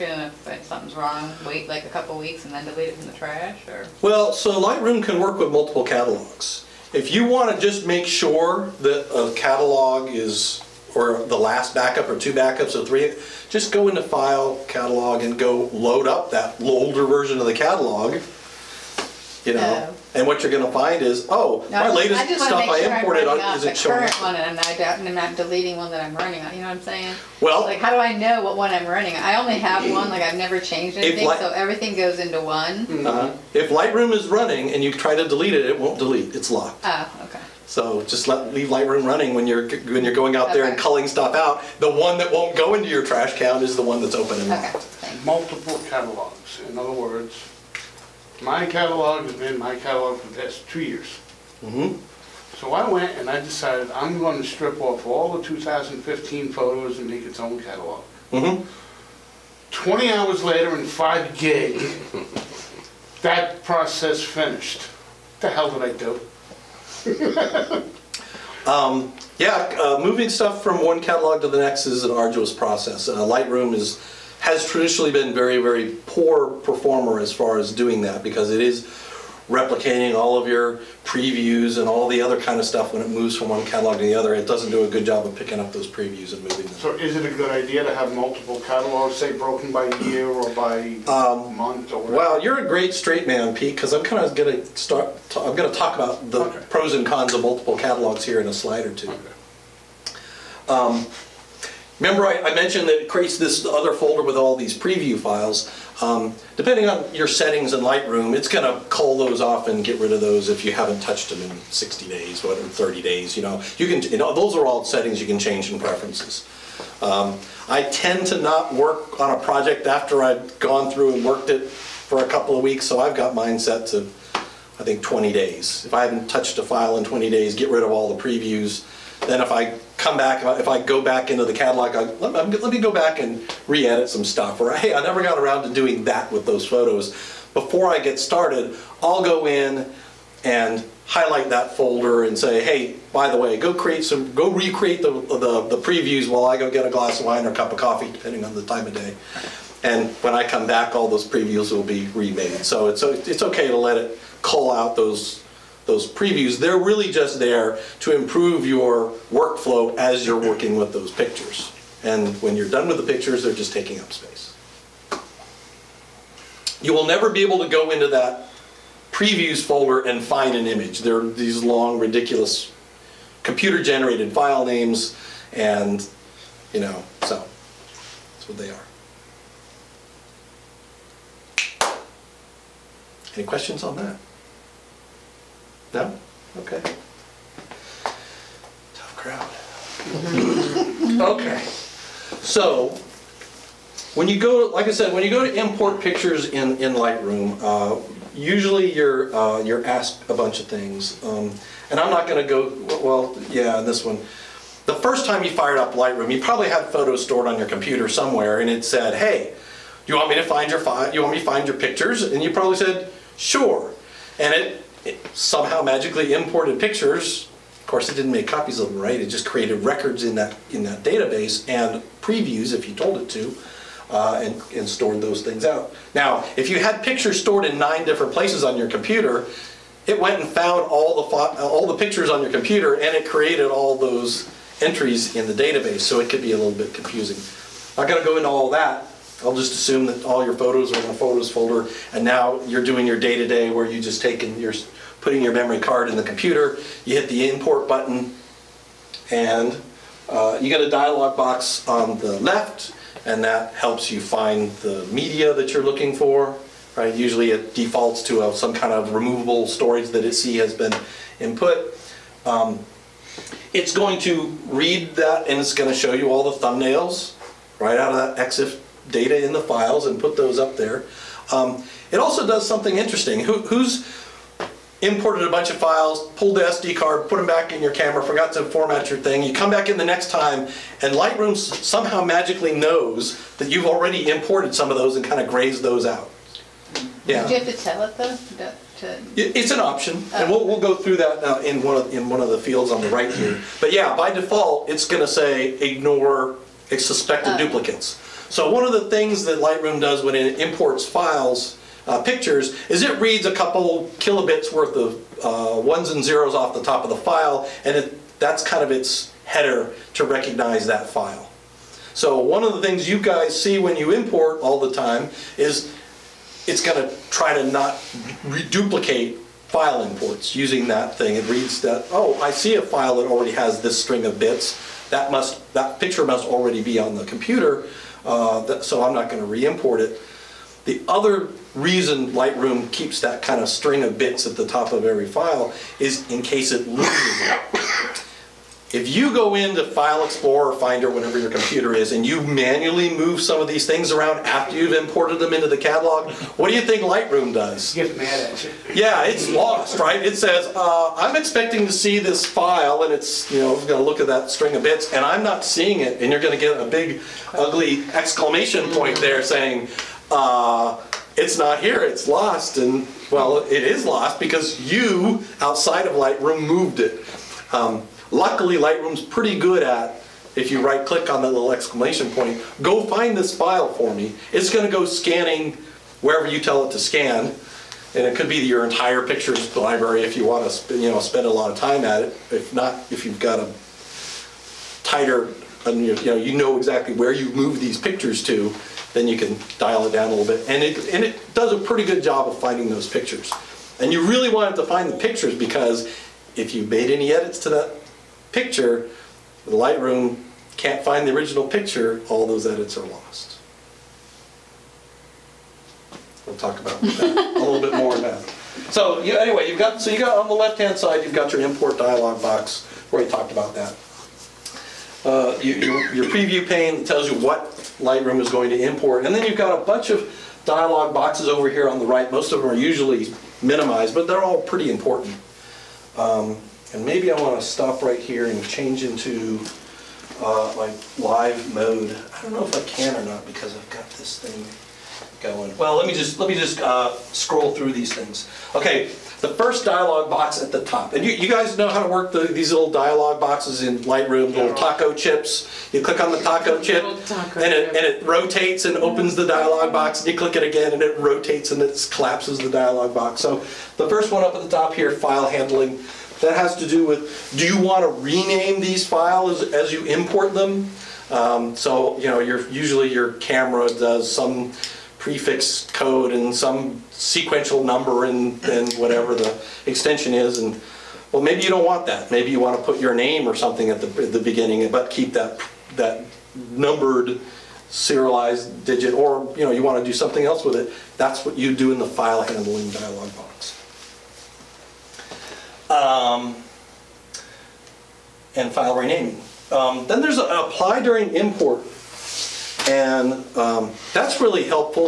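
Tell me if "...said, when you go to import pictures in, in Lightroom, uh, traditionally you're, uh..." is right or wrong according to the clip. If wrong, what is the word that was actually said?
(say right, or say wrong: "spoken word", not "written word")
wrong: "usually", not "traditionally".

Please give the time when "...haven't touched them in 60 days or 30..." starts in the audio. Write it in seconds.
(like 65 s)
110 s.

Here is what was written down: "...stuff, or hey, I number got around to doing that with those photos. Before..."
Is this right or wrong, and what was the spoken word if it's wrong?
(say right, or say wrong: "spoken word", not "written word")
wrong: "never", not "number".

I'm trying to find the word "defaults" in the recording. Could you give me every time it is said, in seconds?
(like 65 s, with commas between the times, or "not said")
257 s, 294 s.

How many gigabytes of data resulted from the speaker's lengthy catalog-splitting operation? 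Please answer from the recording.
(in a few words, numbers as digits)
5.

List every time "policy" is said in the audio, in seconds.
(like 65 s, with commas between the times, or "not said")
not said.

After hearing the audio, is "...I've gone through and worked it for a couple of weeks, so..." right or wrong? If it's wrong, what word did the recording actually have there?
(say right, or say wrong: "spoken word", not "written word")
right.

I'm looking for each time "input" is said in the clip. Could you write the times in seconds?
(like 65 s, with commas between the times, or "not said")
261 s.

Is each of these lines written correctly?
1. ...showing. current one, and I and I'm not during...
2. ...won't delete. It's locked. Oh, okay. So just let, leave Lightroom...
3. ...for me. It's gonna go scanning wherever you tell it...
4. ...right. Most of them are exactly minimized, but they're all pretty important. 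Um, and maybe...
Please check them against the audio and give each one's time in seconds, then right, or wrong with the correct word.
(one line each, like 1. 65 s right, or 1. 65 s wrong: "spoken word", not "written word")
1. 23 s wrong: "deleting", not "during"
2. 35 s right
3. 373 s right
4. 422 s wrong: "usually", not "exactly".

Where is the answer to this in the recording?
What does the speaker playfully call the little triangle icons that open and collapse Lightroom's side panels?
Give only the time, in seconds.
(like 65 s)
444 s.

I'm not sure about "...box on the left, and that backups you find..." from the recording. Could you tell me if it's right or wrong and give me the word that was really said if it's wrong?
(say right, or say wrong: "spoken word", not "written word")
wrong: "helps", not "backups".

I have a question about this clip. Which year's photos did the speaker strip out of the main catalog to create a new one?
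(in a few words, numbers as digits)
2015.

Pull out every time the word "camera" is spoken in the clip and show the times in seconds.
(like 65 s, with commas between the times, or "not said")
277 s, 463 s.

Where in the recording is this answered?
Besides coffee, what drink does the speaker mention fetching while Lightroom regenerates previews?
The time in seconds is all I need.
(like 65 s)
146 s.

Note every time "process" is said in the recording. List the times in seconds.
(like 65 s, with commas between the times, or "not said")
63 s, 72 s.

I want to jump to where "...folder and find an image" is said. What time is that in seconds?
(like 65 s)
169 s.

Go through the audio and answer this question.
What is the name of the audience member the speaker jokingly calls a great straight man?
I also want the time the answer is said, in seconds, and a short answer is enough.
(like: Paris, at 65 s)
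Pete, at 93 s.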